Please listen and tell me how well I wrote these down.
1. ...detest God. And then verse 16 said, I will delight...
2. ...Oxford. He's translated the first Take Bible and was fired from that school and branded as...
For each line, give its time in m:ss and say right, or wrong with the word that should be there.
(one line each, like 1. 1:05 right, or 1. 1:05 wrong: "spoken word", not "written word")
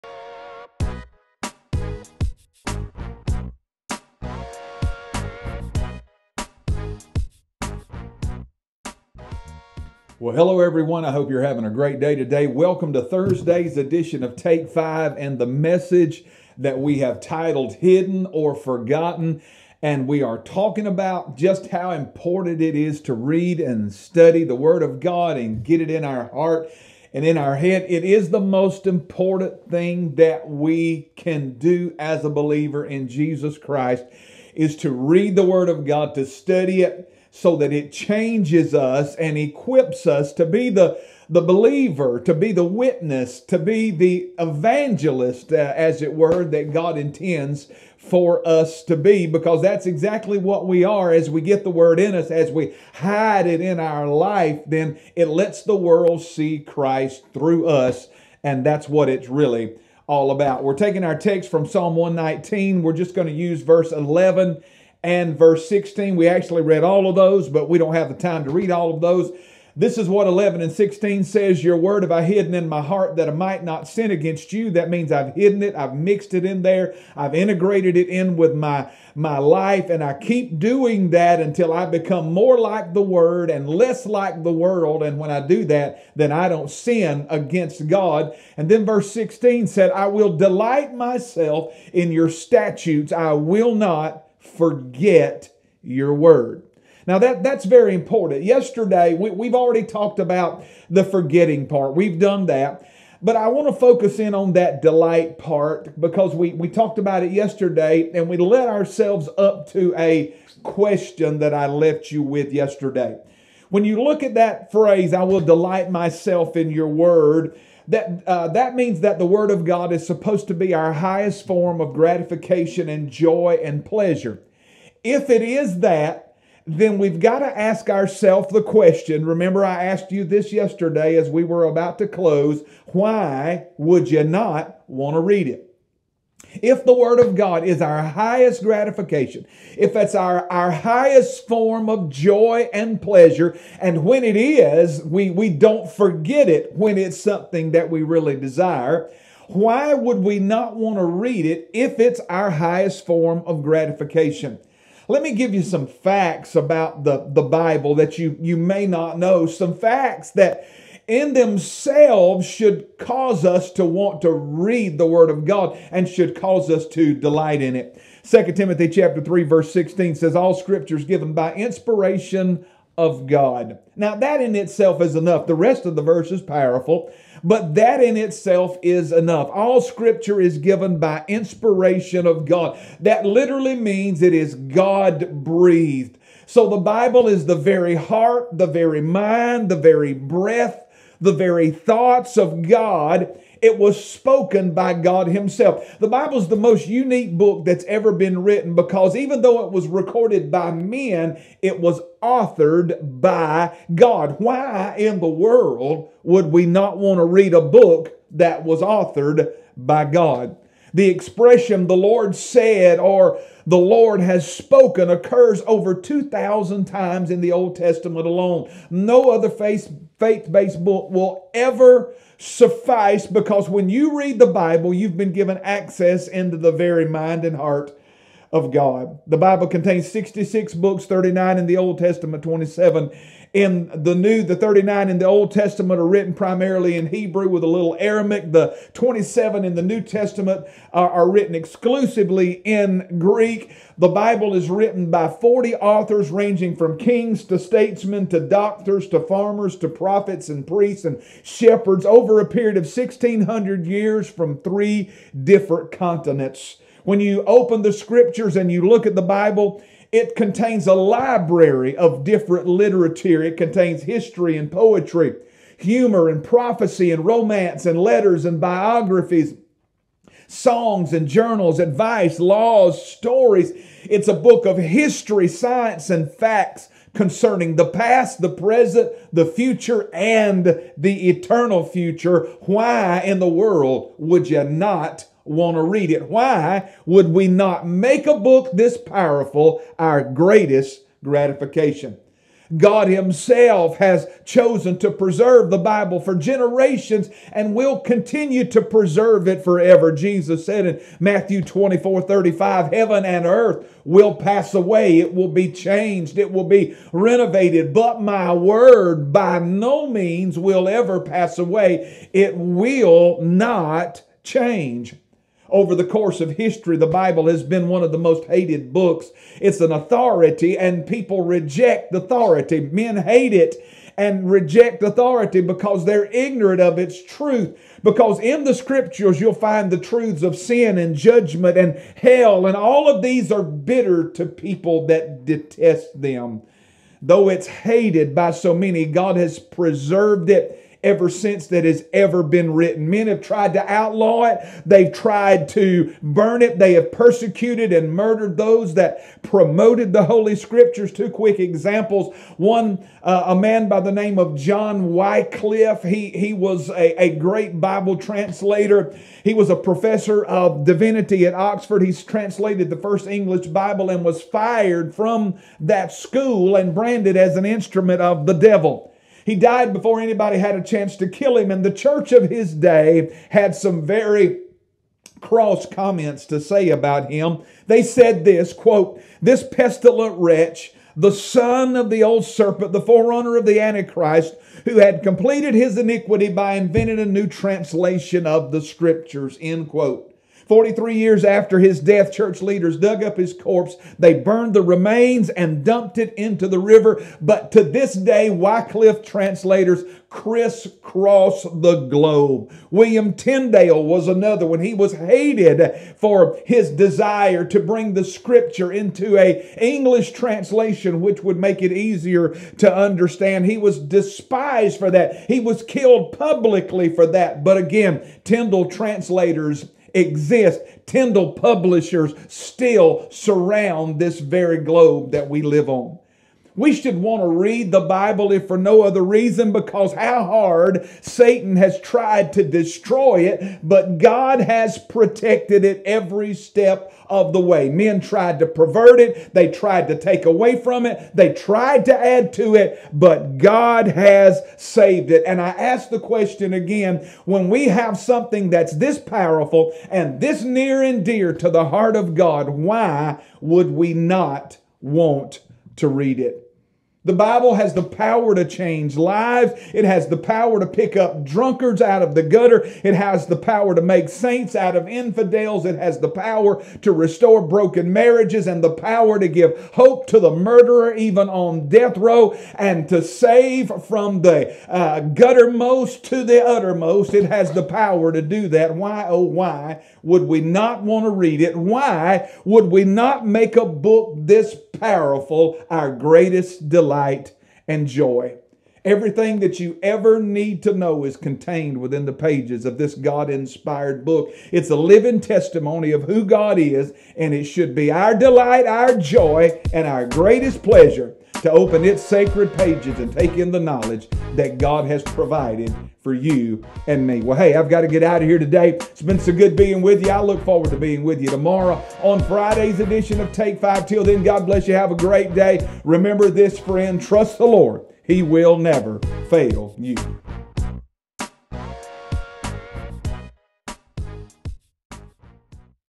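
1. 1:27 wrong: "against", not "detest"
2. 6:01 wrong: "English", not "Take".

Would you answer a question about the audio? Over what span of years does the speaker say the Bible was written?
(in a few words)
1600 years.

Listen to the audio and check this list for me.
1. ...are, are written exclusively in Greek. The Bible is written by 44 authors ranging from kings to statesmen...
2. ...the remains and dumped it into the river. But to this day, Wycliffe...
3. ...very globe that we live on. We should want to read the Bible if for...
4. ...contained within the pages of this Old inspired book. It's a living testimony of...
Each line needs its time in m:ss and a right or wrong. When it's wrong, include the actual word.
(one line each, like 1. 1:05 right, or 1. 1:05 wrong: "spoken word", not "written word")
1. 4:00 wrong: "40", not "44"
2. 6:34 right
3. 7:04 right
4. 8:11 wrong: "God", not "Old".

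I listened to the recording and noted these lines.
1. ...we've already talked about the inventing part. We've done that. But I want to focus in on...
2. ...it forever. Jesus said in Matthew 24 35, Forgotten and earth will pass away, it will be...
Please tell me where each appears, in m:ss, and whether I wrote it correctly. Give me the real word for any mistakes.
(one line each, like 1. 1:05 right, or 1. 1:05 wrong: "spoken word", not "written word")
1. 1:39 wrong: "forgetting", not "inventing"
2. 4:59 wrong: "Heaven", not "Forgotten".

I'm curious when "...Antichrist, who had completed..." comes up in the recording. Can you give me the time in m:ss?
6:23.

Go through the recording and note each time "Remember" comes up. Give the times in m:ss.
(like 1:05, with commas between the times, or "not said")
2:09, 8:36.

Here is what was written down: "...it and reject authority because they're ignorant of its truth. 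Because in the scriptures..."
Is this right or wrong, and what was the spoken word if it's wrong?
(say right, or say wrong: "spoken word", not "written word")
right.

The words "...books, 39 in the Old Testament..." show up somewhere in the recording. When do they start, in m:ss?
3:50.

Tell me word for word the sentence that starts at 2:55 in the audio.
The rest of the verse is powerful, but that in itself is enough.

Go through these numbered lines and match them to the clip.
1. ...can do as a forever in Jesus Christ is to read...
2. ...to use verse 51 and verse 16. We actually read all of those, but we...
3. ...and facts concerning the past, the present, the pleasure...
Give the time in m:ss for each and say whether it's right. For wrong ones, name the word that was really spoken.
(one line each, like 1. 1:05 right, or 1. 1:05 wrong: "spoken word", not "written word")
1. 0:31 wrong: "believer", not "forever"
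2. 1:03 wrong: "11", not "51"
3. 4:36 wrong: "future", not "pleasure".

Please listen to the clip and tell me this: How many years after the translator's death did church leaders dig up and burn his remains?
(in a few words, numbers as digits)
43.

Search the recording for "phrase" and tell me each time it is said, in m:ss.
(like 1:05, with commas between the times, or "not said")
1:54.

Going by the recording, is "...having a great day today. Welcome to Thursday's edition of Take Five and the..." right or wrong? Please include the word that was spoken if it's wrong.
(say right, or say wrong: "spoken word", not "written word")
right.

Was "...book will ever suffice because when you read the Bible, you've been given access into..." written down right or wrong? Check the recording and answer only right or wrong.
right.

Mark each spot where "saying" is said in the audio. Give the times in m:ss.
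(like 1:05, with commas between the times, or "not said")
not said.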